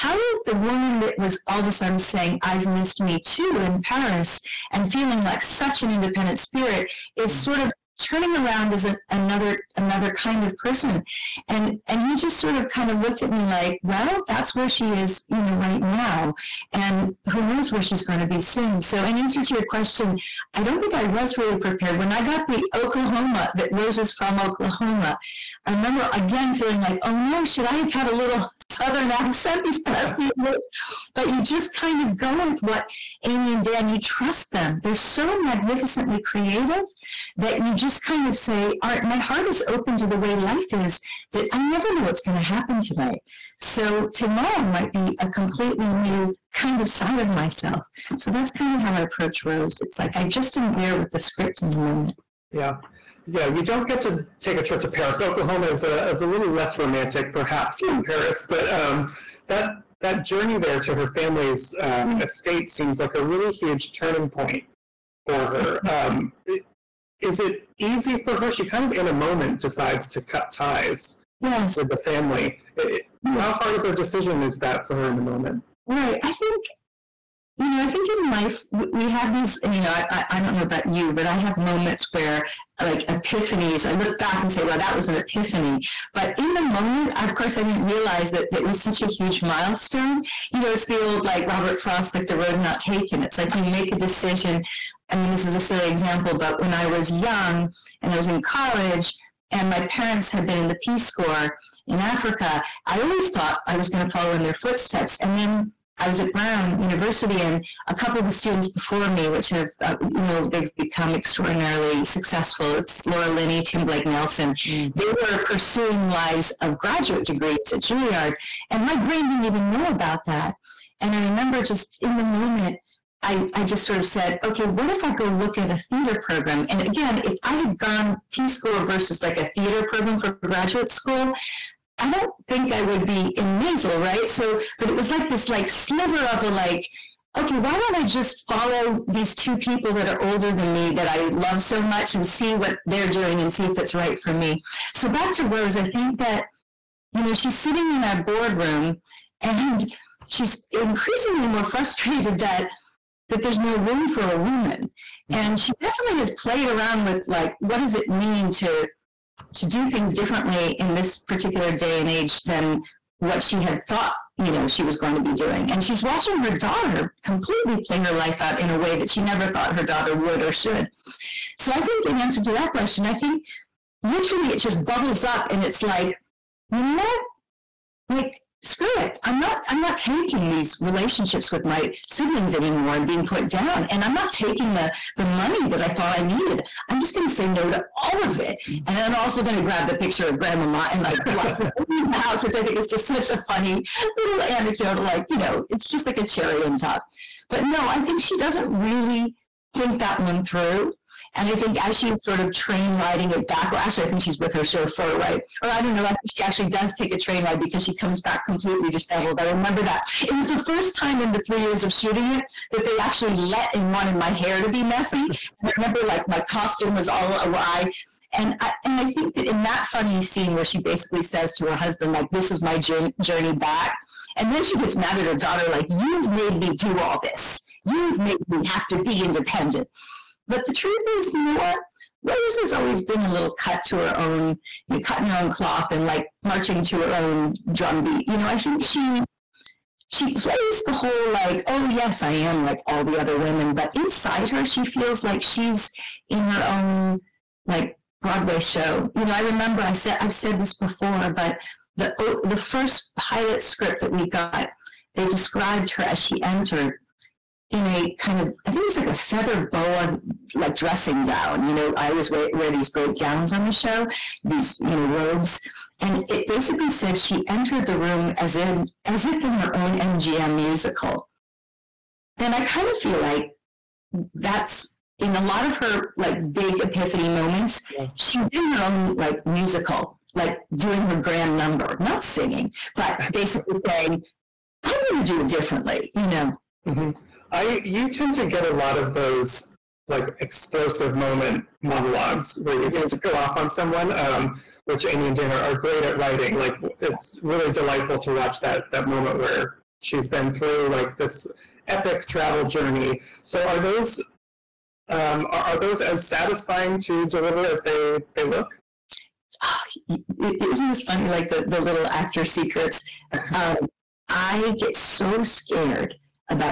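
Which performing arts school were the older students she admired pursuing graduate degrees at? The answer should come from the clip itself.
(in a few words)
Juilliard.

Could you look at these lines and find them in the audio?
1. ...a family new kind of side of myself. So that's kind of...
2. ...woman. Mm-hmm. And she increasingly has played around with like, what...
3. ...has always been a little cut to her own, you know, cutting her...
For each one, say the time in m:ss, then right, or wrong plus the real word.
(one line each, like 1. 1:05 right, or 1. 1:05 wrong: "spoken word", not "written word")
1. 0:45 wrong: "completely", not "family"
2. 2:34 wrong: "definitely", not "increasingly"
3. 3:52 right.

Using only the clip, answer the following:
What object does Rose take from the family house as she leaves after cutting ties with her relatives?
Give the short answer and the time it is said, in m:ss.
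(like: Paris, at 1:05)
picture of grandmama, at 3:09.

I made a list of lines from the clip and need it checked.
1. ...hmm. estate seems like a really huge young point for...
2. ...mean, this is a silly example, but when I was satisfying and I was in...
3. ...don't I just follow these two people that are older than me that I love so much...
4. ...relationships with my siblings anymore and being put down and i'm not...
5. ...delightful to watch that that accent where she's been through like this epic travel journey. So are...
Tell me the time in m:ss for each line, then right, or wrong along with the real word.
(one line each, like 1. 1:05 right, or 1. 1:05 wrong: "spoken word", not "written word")
1. 1:02 wrong: "turning", not "young"
2. 1:35 wrong: "young", not "satisfying"
3. 2:17 right
4. 3:00 right
5. 4:57 wrong: "moment", not "accent".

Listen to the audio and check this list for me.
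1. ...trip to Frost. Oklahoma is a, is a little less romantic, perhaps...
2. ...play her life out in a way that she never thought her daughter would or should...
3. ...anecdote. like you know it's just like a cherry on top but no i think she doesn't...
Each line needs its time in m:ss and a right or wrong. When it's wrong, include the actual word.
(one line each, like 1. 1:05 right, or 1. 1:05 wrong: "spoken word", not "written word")
1. 0:54 wrong: "Paris", not "Frost"
2. 2:47 right
3. 3:14 right.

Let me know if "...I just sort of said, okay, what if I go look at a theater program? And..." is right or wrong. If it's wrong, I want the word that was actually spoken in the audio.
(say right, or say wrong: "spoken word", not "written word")
right.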